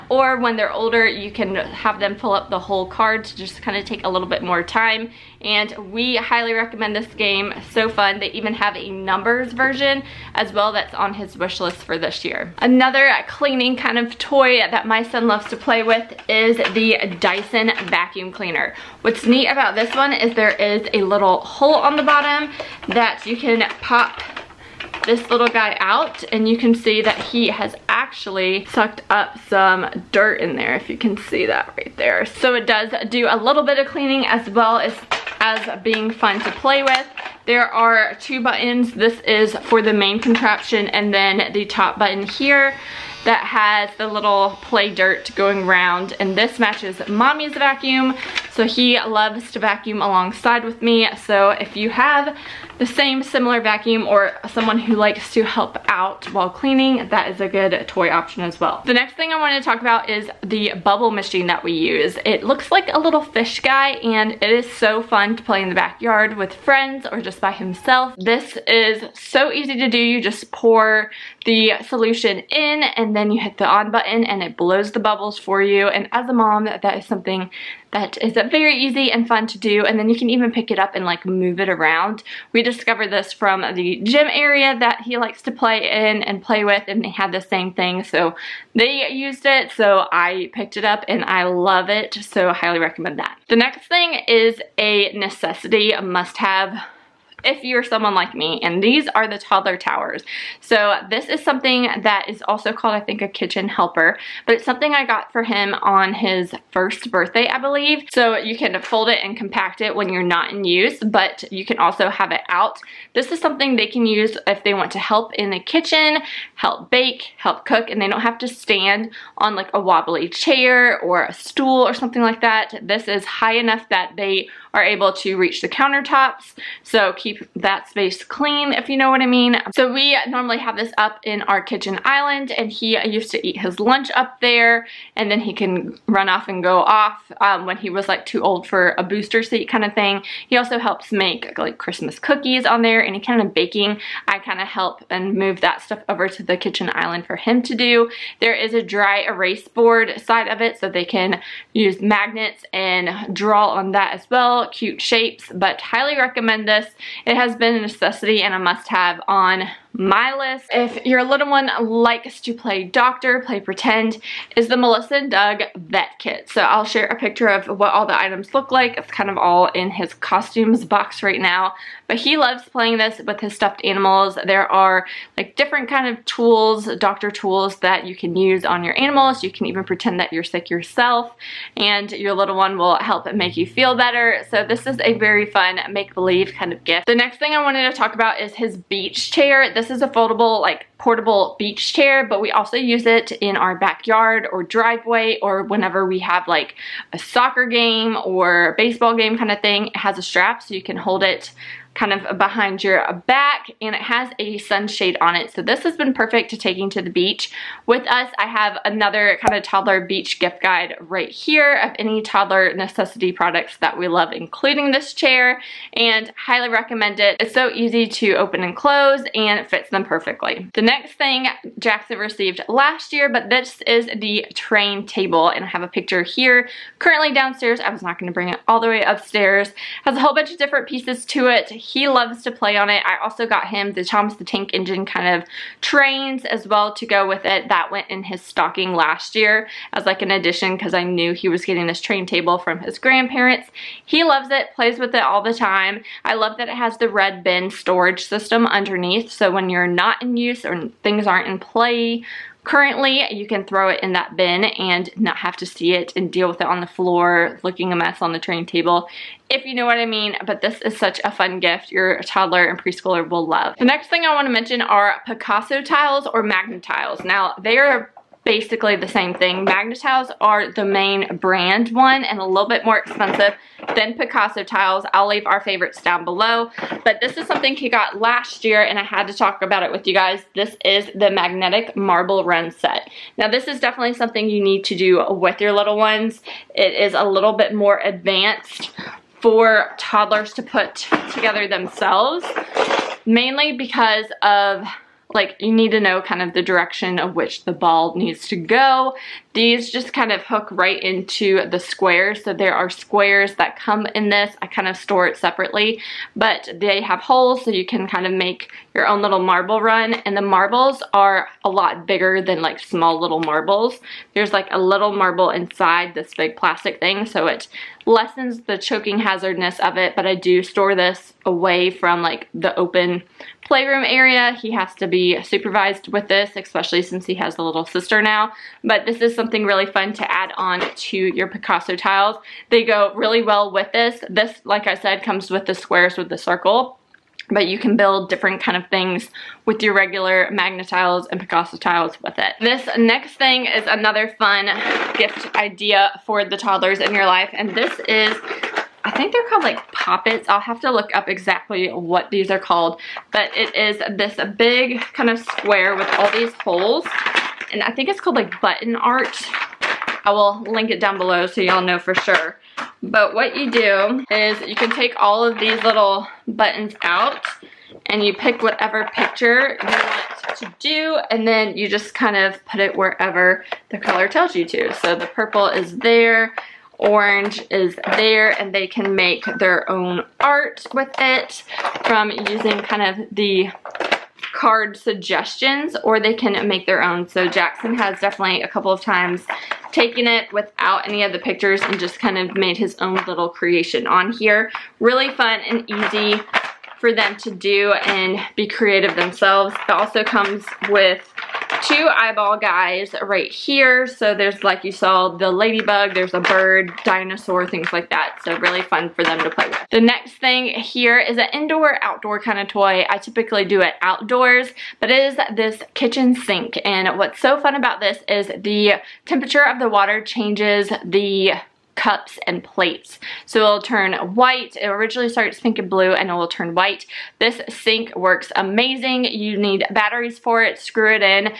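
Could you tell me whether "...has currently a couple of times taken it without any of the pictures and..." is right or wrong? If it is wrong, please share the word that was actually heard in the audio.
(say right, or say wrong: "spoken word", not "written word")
wrong: "definitely", not "currently".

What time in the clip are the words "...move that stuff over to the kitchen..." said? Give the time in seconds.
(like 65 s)
145 s.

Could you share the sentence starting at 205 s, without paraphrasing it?
So this has been perfect to taking to the beach.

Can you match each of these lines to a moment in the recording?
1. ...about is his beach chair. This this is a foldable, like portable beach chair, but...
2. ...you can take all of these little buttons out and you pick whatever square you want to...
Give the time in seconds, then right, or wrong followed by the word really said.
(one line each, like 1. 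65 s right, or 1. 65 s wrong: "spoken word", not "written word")
1. 188 s right
2. 364 s wrong: "picture", not "square".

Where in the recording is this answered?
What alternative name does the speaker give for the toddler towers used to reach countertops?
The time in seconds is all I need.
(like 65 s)
103 s.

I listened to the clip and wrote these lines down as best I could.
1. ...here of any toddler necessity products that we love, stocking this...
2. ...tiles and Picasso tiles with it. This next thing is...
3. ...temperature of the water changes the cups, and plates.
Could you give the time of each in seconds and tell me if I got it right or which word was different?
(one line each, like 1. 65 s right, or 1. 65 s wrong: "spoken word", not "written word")
1. 211 s wrong: "including", not "stocking"
2. 340 s right
3. 419 s right.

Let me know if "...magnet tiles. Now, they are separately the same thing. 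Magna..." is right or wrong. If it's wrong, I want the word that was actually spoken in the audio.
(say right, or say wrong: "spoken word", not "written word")
wrong: "basically", not "separately".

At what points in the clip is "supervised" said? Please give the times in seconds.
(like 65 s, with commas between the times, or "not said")
325 s.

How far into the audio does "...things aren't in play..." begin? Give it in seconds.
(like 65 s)
251 s.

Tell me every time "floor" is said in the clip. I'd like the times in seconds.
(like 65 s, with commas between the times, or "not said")
256 s.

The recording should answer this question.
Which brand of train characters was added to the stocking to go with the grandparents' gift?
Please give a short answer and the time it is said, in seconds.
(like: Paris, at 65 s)
Thomas the Tank Engine, at 234 s.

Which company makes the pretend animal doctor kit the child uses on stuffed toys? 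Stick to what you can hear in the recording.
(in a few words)
Melissa and Doug.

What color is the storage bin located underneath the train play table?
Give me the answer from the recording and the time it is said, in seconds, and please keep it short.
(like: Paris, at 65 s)
Red, at 247 s.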